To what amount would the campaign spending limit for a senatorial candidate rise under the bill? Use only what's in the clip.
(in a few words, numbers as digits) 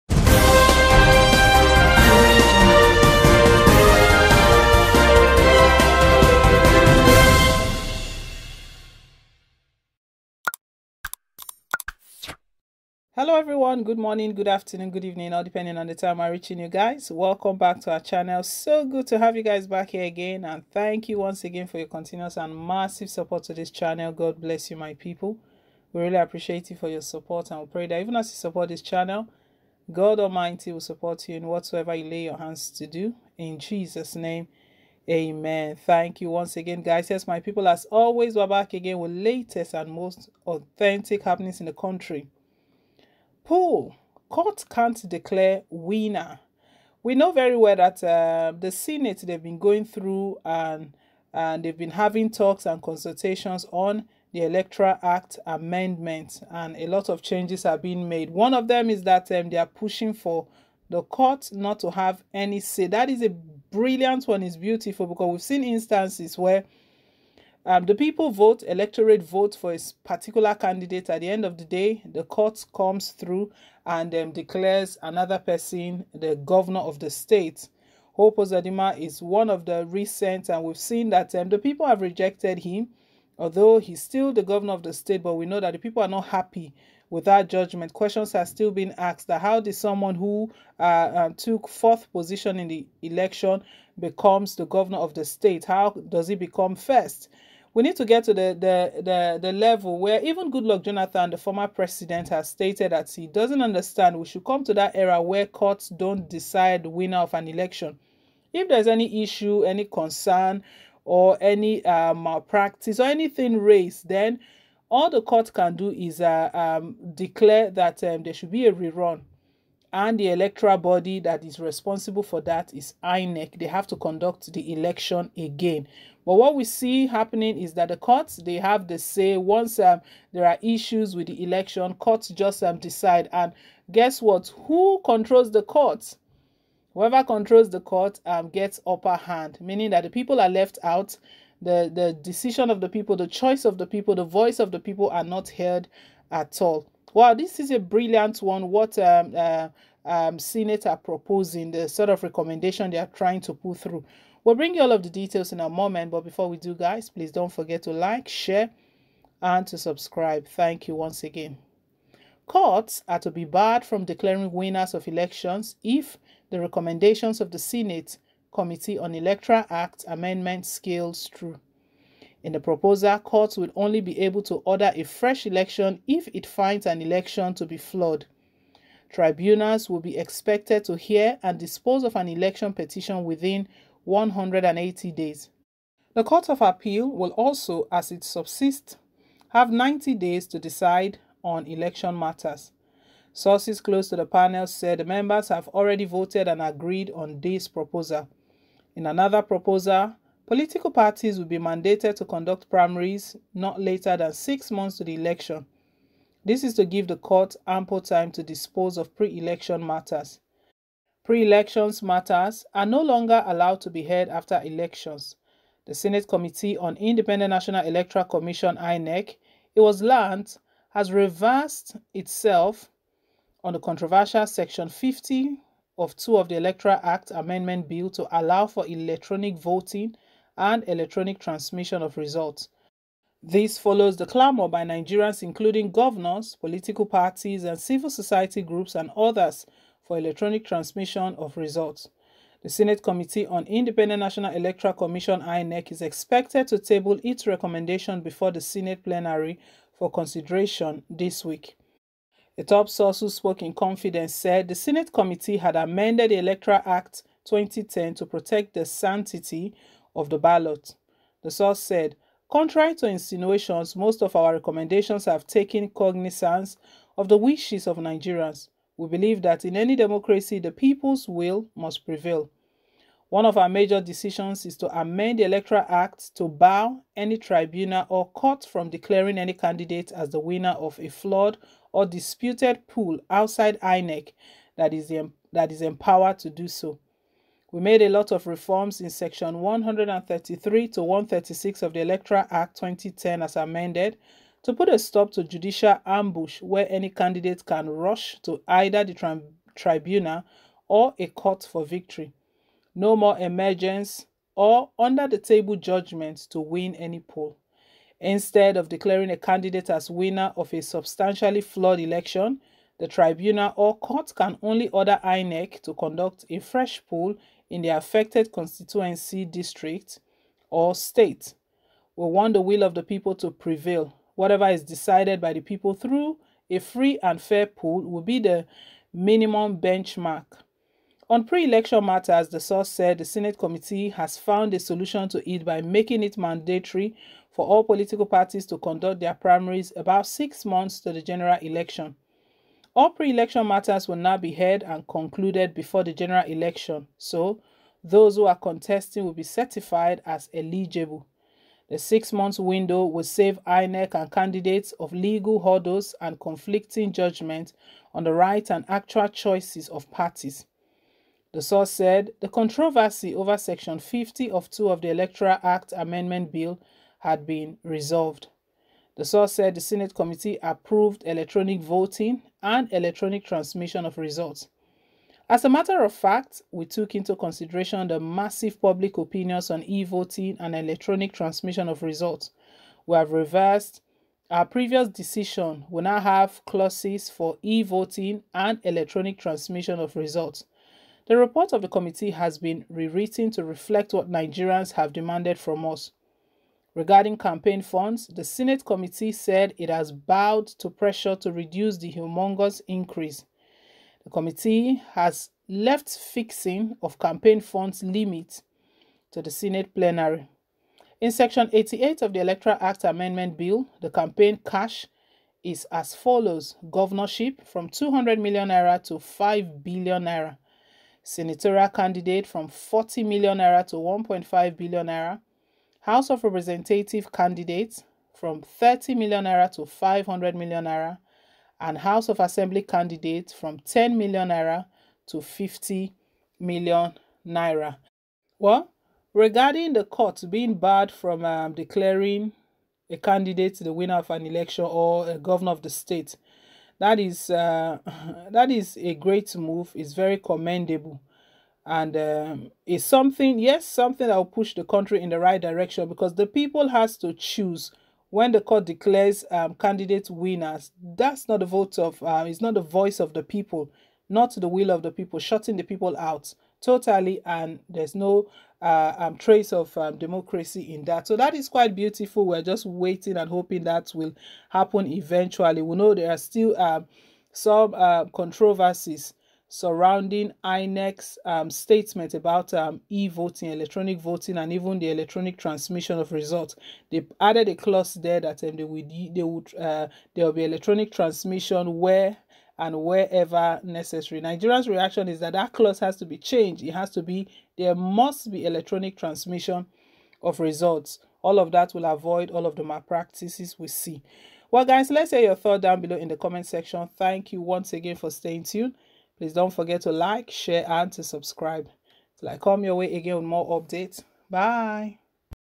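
1.5 billion naira.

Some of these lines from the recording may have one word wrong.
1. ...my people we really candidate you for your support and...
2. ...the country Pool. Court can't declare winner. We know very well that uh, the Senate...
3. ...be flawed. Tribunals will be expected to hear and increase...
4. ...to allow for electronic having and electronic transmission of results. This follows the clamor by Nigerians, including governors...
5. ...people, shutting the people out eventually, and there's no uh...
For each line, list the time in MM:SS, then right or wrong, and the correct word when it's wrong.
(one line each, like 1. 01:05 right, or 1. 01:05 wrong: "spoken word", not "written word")
1. 00:24 wrong: "appreciate", not "candidate"
2. 00:41 right
3. 02:57 wrong: "dispose", not "increase"
4. 03:48 wrong: "voting", not "having"
5. 07:45 wrong: "totally", not "eventually".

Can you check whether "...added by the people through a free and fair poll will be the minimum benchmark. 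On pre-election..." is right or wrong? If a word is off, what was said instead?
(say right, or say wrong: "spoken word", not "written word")
wrong: "decided", not "added".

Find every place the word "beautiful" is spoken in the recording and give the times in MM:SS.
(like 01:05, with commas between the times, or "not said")
01:04, 07:51.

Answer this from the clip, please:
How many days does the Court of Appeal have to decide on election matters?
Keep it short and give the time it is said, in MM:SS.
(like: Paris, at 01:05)
90 days, at 03:09.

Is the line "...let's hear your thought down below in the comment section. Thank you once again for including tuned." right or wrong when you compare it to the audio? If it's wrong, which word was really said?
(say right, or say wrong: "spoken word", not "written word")
wrong: "staying", not "including".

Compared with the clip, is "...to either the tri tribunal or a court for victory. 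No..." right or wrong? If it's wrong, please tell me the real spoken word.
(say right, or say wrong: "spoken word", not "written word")
right.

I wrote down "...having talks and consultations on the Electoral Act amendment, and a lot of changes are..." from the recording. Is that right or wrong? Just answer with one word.
right.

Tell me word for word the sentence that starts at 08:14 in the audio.
Nigeria's reaction is that that clause has to be changed.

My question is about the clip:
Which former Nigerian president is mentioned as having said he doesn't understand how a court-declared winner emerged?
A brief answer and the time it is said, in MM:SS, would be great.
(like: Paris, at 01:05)
Goodluck Jonathan, at 01:40.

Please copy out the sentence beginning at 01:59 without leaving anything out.
And the electoral body that is responsible for that is INEC.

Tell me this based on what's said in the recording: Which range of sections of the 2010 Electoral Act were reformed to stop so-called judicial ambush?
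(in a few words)
Sections 133 to 136.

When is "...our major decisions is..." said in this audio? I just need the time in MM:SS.
04:33.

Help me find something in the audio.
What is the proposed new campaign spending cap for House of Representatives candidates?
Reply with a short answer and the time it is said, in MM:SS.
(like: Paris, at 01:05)
500 million naira, at 07:09.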